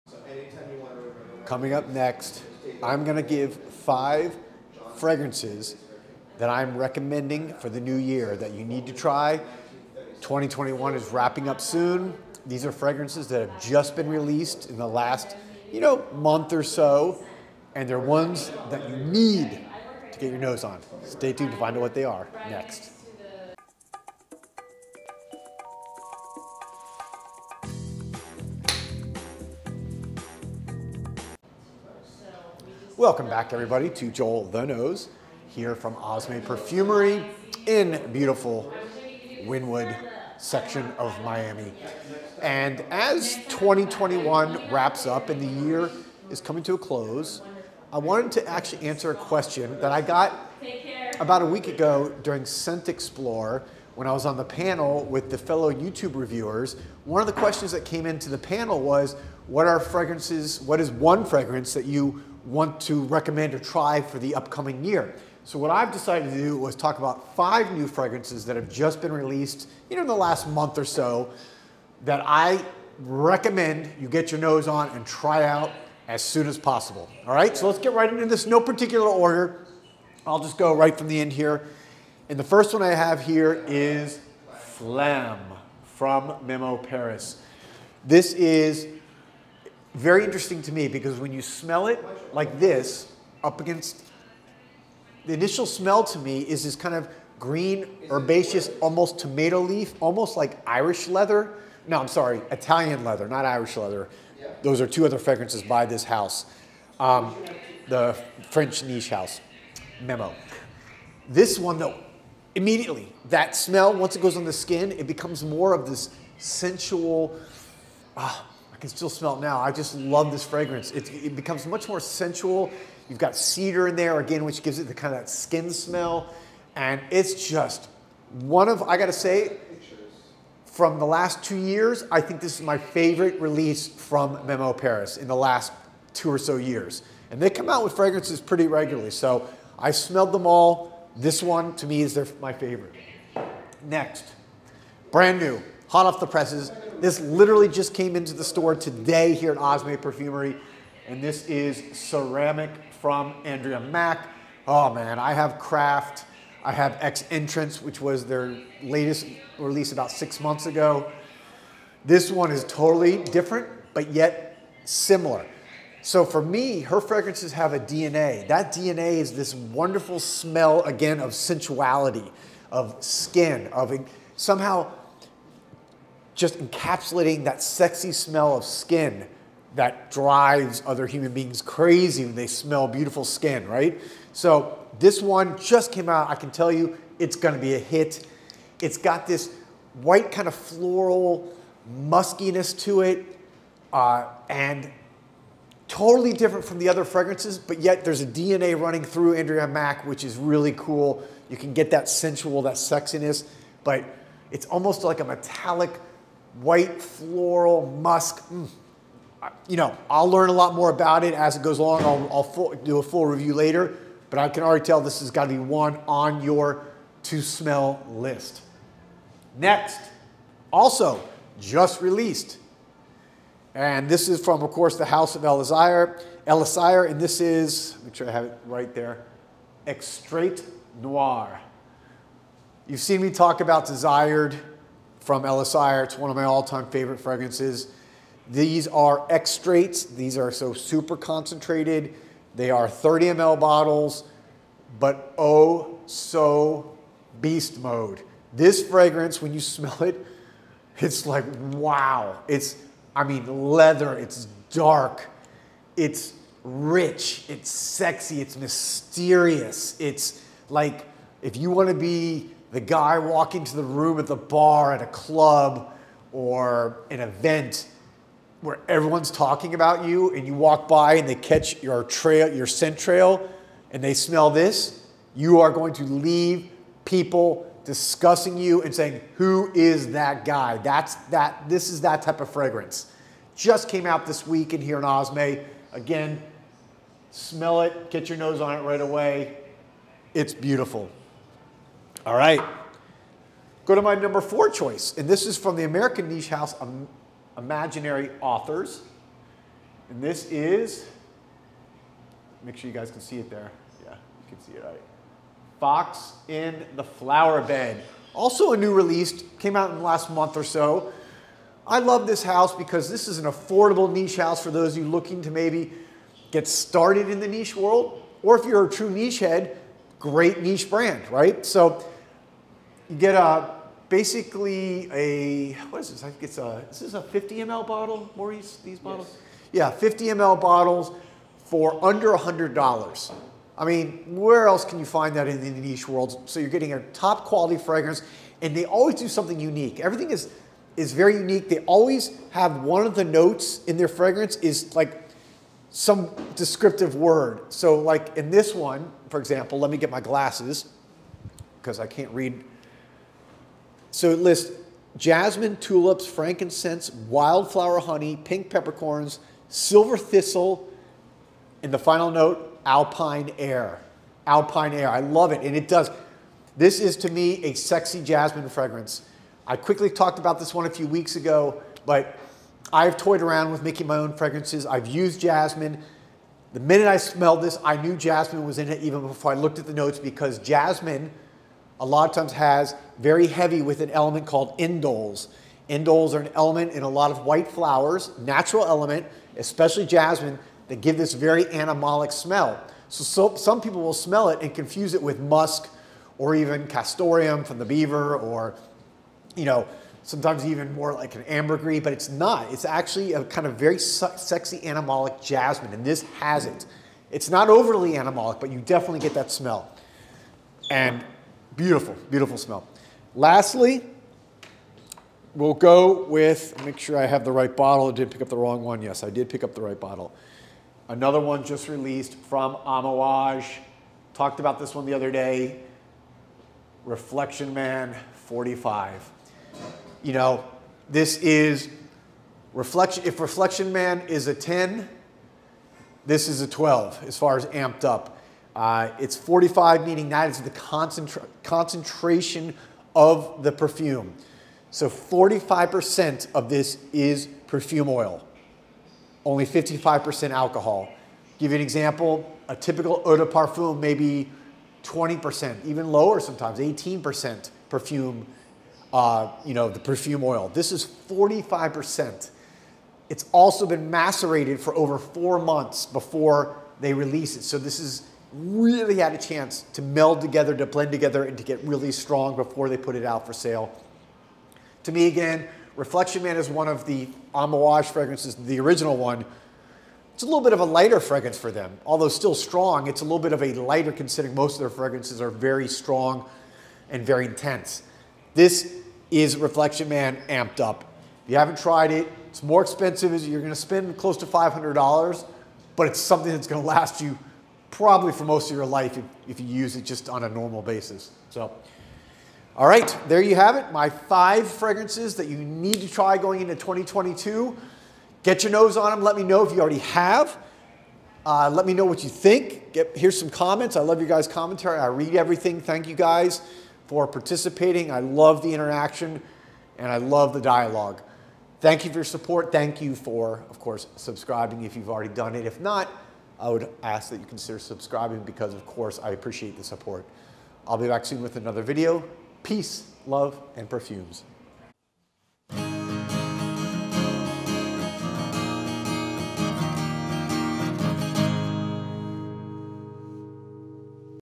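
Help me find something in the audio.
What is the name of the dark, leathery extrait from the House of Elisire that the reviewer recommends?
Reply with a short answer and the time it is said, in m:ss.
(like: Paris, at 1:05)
Extrait Noir, at 3:49.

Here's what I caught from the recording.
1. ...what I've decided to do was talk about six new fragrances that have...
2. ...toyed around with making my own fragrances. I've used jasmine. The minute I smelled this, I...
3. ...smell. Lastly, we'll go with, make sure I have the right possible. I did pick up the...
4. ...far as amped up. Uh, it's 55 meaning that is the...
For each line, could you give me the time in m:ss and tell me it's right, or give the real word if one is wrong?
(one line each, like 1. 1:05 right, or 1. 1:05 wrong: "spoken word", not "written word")
1. 1:05 wrong: "five", not "six"
2. 6:13 right
3. 6:52 wrong: "bottle", not "possible"
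4. 7:17 wrong: "45", not "55".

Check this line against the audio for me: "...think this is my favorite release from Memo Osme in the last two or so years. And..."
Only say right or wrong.
wrong.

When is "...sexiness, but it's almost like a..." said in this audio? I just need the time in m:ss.
3:22.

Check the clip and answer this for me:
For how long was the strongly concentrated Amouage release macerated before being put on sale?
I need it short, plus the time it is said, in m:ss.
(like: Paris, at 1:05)
Over four months, at 7:44.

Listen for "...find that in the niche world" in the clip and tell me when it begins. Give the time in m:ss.
5:35.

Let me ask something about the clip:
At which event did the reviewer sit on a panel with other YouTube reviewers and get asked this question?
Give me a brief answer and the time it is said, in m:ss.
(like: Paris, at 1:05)
Scent Explore, at 0:52.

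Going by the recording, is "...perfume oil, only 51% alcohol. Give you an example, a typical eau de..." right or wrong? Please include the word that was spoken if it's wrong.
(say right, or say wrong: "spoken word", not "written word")
wrong: "55", not "51".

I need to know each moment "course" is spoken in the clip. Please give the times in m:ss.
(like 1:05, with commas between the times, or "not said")
3:44, 8:43, 8:48.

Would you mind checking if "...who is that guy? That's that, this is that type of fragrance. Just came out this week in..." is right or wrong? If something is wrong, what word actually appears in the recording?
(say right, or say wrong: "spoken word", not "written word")
right.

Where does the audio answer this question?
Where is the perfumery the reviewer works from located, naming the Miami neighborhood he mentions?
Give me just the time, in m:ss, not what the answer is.
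0:39.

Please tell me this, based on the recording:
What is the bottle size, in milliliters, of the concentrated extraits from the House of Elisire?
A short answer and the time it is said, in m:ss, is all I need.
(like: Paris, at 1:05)
30 ml, at 4:02.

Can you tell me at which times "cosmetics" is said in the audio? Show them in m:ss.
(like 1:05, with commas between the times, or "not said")
not said.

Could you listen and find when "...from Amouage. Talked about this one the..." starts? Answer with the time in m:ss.
7:02.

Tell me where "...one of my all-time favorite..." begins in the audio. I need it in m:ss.
3:56.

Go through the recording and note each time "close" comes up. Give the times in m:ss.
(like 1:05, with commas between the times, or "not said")
0:46, 8:14.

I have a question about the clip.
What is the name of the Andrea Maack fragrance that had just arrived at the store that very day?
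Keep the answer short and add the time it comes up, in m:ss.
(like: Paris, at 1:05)
Ceramic, at 2:31.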